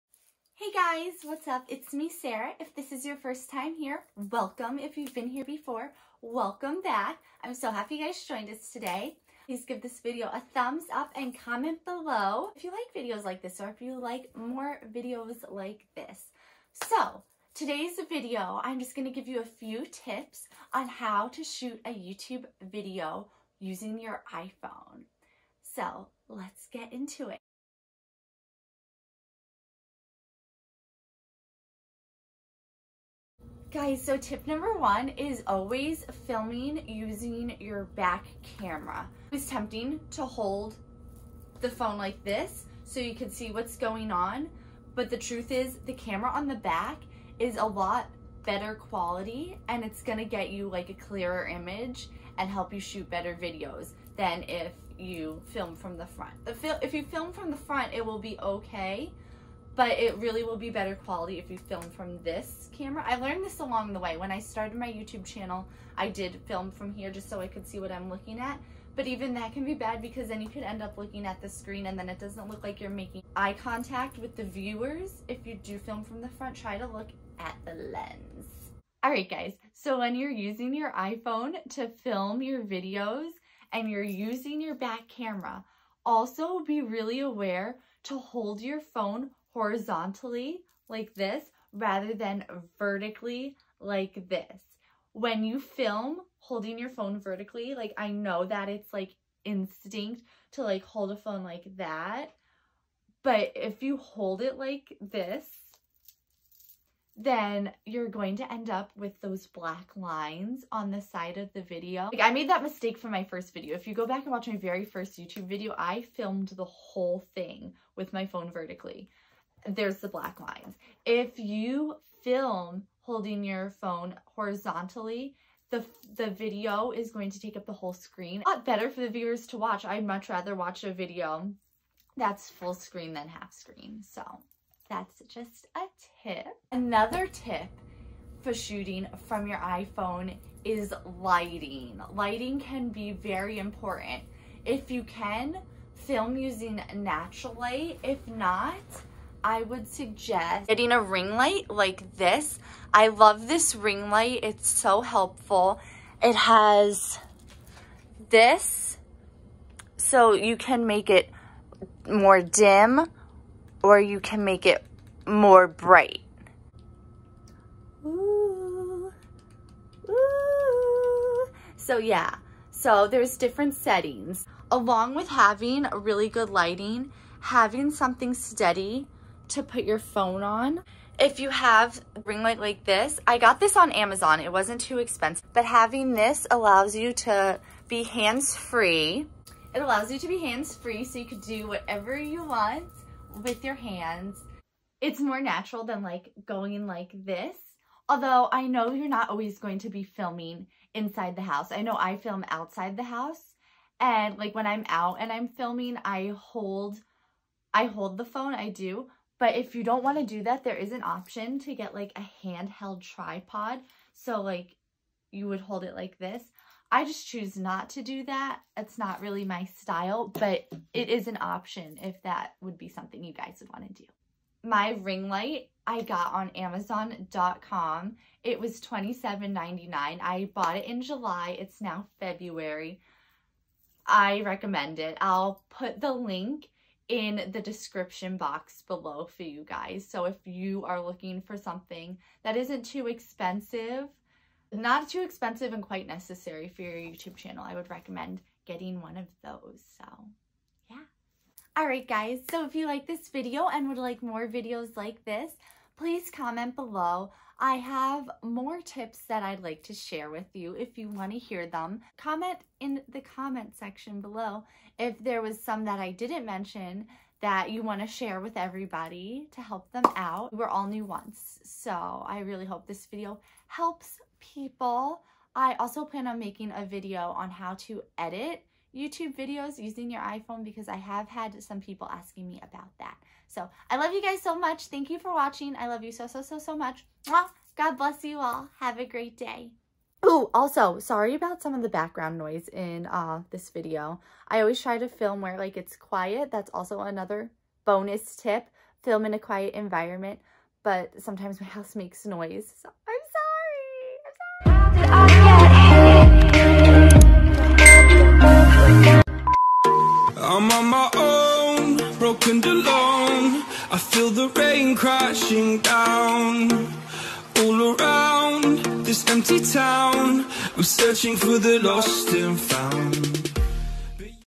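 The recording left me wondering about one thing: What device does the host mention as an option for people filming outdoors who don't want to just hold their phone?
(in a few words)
handheld tripod.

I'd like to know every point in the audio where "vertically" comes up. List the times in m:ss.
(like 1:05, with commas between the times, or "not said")
1:32, 1:37, 1:58.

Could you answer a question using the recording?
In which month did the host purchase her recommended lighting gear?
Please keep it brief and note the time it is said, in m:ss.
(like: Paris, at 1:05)
July, at 3:51.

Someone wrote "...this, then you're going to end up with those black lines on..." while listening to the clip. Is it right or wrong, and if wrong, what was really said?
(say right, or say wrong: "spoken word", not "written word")
right.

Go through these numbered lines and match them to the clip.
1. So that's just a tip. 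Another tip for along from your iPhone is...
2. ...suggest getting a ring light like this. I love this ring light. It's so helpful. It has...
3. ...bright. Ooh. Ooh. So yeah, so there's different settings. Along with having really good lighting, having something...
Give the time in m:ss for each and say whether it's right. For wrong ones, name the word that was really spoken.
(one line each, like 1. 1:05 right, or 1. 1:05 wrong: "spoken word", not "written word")
1. 2:14 wrong: "shooting", not "along"
2. 2:29 right
3. 2:45 right.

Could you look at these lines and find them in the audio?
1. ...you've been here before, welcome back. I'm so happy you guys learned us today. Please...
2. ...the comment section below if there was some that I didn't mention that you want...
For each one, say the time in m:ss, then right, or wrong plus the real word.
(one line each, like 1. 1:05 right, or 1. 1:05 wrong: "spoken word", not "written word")
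1. 0:04 wrong: "joined", not "learned"
2. 4:23 right.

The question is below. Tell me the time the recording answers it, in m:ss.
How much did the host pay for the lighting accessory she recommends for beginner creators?
3:48.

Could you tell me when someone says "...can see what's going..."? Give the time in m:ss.
0:43.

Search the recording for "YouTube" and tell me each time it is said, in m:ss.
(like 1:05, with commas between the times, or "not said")
0:21, 1:04, 1:55, 4:06, 4:38.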